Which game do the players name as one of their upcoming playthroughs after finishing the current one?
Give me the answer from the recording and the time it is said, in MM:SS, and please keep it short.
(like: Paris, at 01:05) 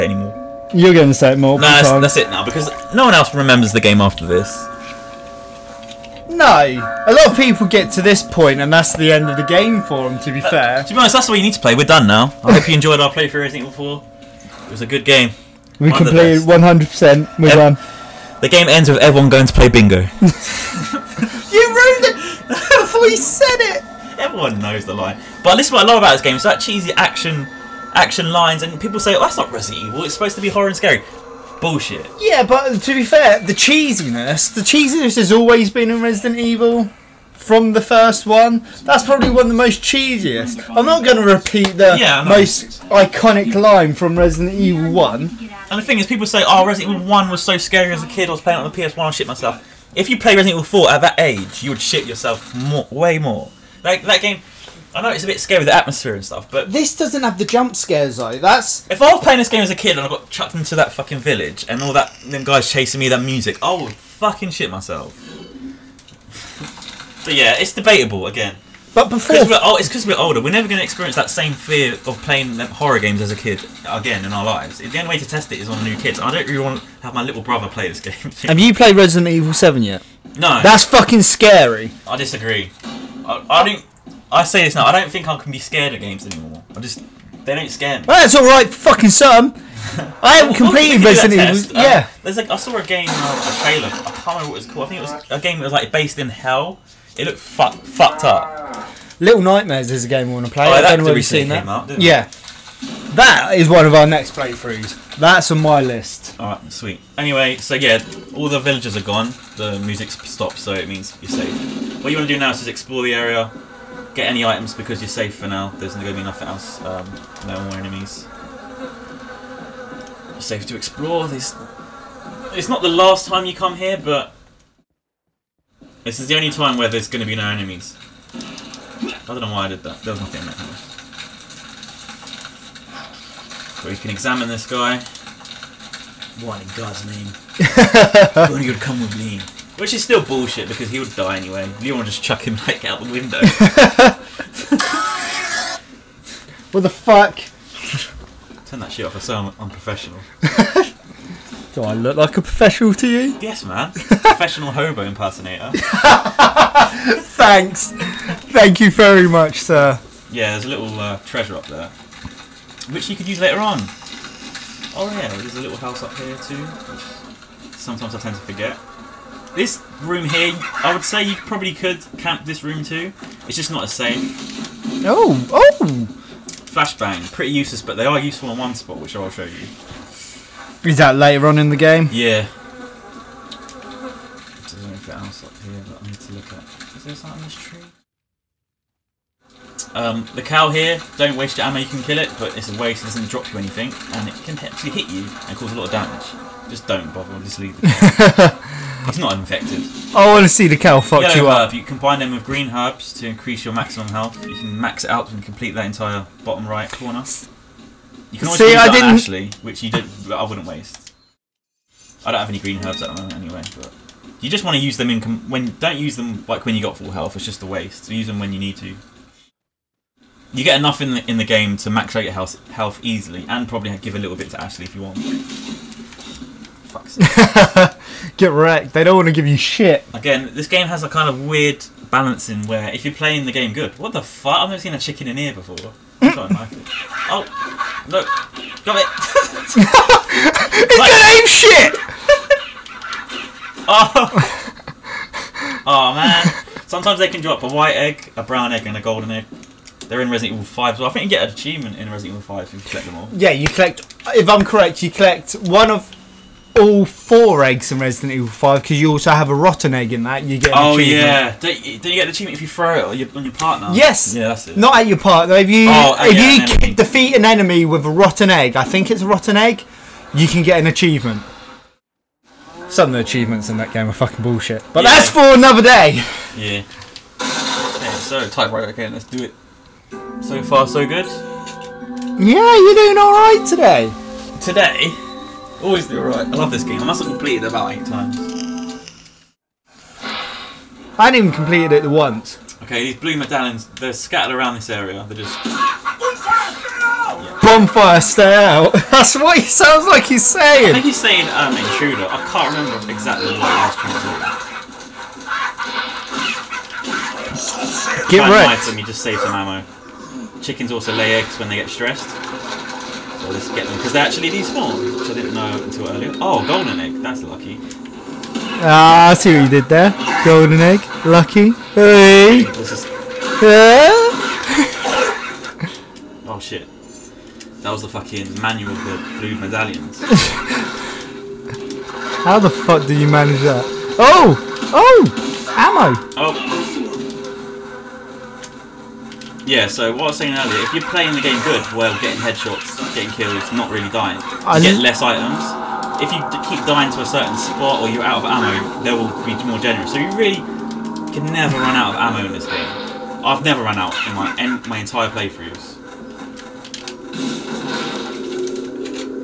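Little Nightmares, at 01:39.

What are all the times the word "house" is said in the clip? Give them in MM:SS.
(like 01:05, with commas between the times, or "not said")
02:10, 02:45.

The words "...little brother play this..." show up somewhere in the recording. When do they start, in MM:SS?
01:17.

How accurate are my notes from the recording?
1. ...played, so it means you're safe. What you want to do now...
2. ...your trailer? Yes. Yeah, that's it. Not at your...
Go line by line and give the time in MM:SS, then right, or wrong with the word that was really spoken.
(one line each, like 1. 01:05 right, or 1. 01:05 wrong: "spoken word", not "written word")
1. 01:50 wrong: "stopped", not "played"
2. 04:23 wrong: "partner", not "trailer".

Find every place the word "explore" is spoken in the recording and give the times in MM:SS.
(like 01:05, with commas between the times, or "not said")
01:52, 02:00.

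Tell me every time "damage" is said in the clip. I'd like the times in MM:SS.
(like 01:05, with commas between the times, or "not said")
03:15.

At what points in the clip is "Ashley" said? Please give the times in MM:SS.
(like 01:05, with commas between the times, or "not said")
03:29, 03:44.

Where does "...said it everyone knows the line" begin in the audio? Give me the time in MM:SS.
00:23.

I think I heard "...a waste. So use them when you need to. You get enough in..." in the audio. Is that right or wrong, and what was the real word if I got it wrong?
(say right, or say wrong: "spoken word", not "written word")
right.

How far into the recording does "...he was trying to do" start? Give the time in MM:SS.
05:03.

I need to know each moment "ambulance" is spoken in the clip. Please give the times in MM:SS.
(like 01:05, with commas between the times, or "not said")
not said.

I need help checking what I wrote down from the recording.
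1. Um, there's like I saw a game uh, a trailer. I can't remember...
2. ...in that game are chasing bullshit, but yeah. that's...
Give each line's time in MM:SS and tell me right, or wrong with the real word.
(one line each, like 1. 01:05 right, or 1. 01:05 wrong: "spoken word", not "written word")
1. 01:32 right
2. 04:33 wrong: "fucking", not "chasing".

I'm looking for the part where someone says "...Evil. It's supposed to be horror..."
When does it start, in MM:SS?
00:29.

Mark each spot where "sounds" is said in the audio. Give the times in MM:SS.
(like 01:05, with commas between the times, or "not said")
04:59.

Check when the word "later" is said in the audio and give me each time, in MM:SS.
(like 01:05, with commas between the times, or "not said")
02:43, 03:01.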